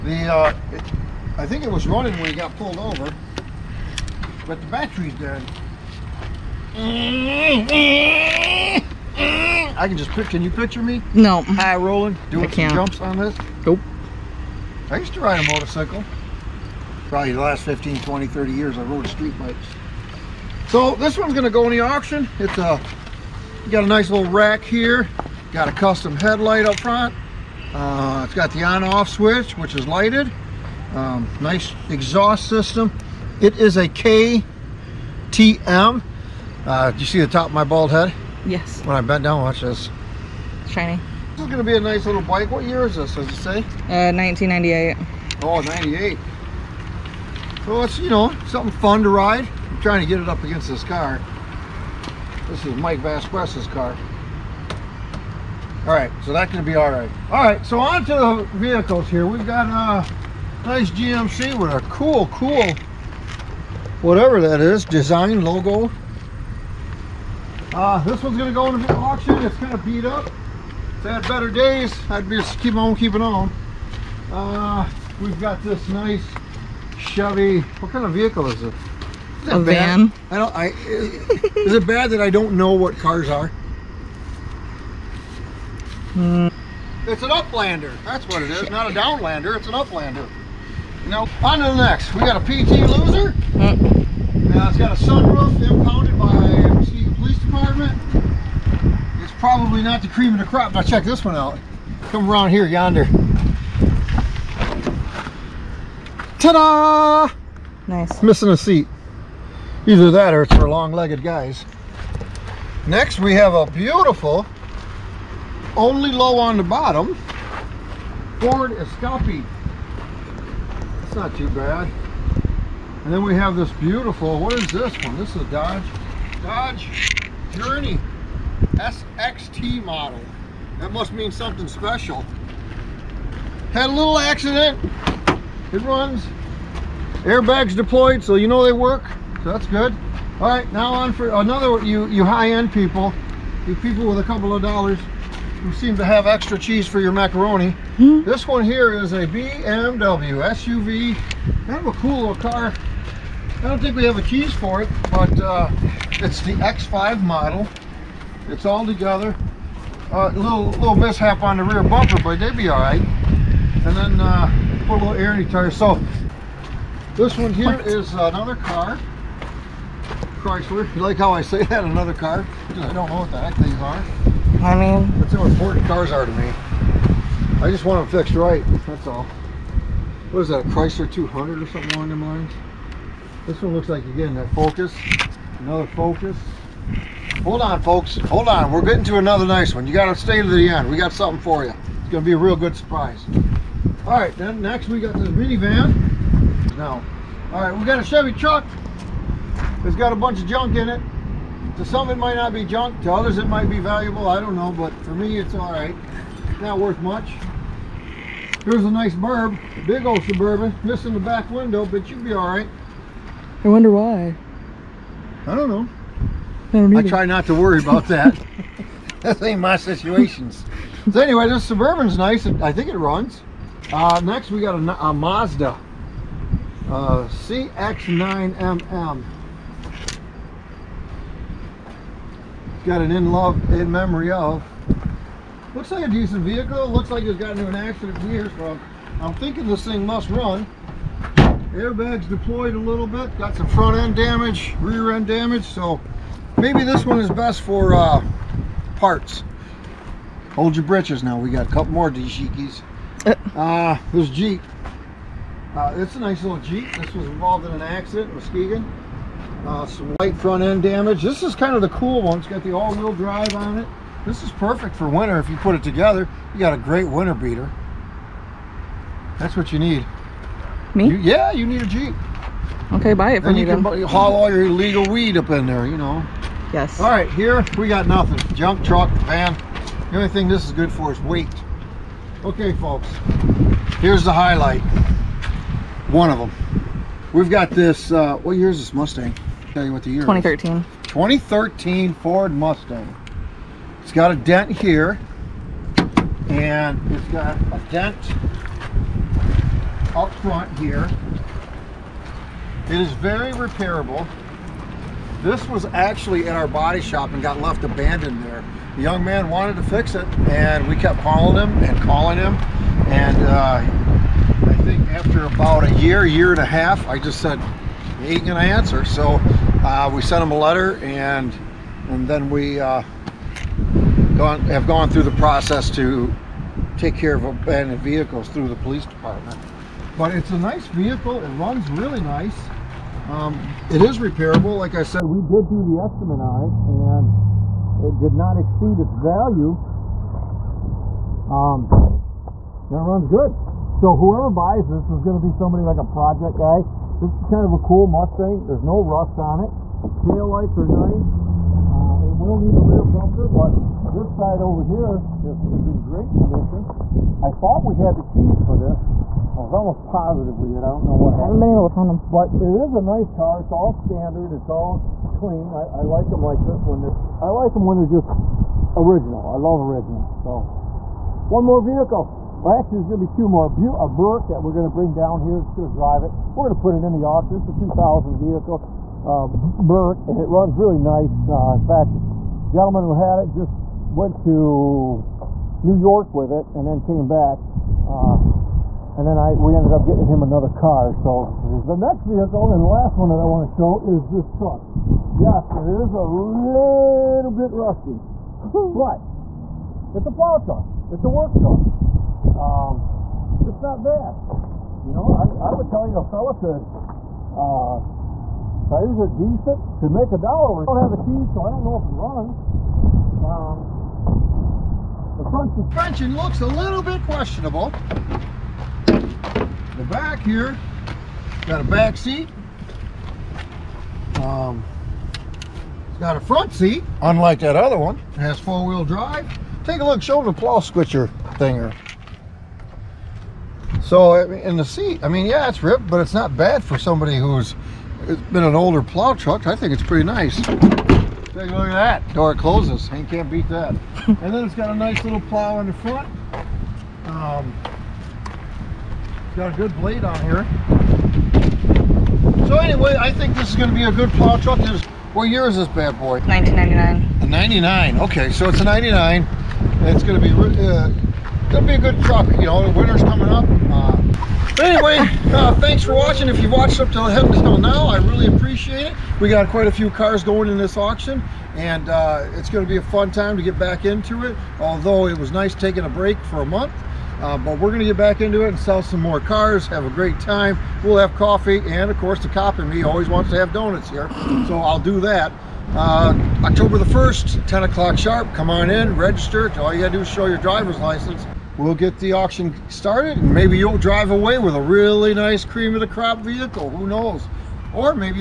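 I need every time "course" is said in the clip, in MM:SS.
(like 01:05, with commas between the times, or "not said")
08:02.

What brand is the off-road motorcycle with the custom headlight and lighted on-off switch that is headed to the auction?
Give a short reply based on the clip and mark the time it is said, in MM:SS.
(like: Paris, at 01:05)
KTM, at 00:33.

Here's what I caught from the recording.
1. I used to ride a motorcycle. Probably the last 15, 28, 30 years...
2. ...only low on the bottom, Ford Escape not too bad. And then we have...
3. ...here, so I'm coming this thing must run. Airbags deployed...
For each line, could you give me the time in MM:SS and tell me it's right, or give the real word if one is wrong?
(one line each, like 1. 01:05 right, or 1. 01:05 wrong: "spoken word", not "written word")
1. 00:14 wrong: "20", not "28"
2. 01:55 right
3. 03:58 wrong: "thinking", not "coming".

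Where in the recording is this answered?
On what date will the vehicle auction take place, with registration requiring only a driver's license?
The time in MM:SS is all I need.
08:06.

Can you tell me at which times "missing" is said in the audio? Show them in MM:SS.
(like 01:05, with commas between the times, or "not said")
01:48, 03:30.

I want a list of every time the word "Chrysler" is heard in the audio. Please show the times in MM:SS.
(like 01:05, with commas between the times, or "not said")
02:50, 03:00.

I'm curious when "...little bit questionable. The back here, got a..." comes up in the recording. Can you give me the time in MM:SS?
06:56.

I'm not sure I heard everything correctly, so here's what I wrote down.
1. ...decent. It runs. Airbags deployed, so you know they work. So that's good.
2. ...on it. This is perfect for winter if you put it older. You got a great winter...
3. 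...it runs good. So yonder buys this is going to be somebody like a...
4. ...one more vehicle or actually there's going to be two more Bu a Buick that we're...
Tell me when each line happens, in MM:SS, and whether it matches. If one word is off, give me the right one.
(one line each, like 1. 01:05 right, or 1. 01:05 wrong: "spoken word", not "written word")
1. 02:14 wrong: "accident", not "decent"
2. 04:23 wrong: "together", not "older"
3. 05:42 wrong: "whoever", not "yonder"
4. 06:11 right.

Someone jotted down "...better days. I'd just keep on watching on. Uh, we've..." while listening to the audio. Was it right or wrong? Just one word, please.
wrong.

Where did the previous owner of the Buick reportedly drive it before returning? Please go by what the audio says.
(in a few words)
New York.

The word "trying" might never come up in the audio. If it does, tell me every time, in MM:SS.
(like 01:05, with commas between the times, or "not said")
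00:49.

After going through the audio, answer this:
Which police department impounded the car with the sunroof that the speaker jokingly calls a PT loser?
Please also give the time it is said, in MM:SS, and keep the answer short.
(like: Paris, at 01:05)
Muskegon Police Department, at 01:36.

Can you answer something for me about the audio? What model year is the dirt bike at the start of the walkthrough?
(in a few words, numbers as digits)
1998.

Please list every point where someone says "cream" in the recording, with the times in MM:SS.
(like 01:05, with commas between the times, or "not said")
01:40, 08:15.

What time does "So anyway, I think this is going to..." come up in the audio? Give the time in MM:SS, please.
07:32.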